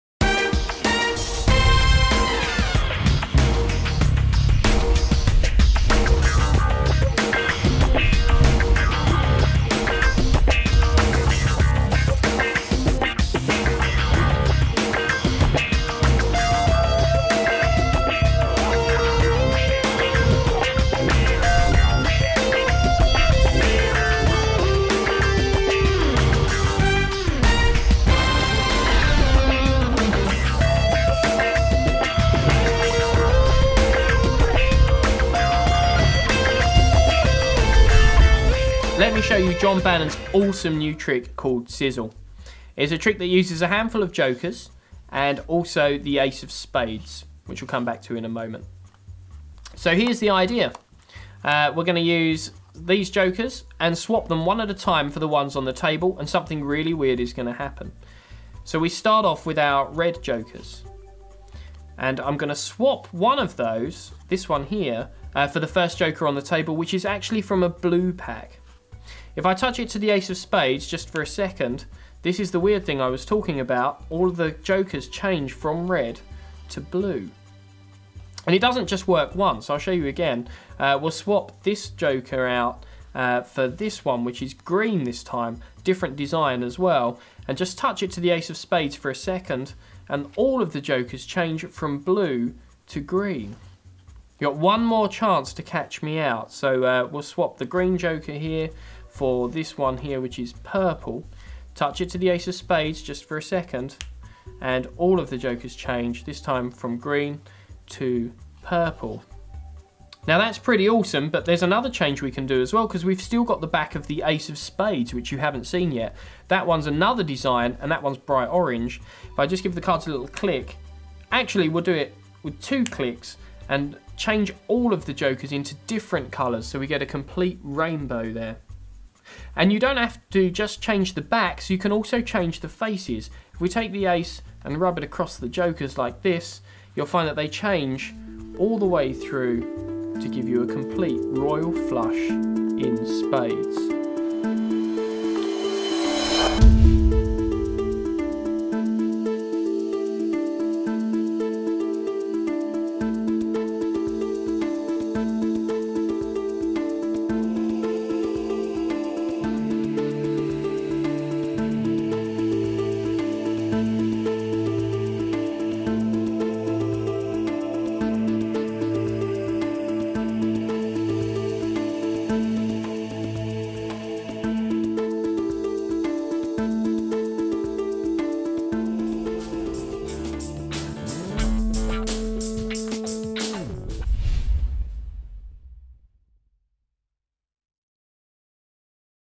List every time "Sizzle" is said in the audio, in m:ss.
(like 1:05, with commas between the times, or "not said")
0:41.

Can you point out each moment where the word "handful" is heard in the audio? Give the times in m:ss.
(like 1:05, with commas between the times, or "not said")
0:43.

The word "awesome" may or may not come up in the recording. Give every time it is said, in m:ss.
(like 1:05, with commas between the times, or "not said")
0:40, 1:50.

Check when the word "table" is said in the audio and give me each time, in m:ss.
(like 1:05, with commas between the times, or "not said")
0:55, 1:06.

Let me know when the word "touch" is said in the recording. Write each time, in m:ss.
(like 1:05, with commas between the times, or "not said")
1:09, 1:27, 1:41.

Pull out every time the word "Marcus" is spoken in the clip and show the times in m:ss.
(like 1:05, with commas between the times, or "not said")
not said.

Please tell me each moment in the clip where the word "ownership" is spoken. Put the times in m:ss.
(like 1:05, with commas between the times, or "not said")
not said.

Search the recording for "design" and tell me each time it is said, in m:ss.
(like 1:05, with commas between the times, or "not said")
1:26, 1:57.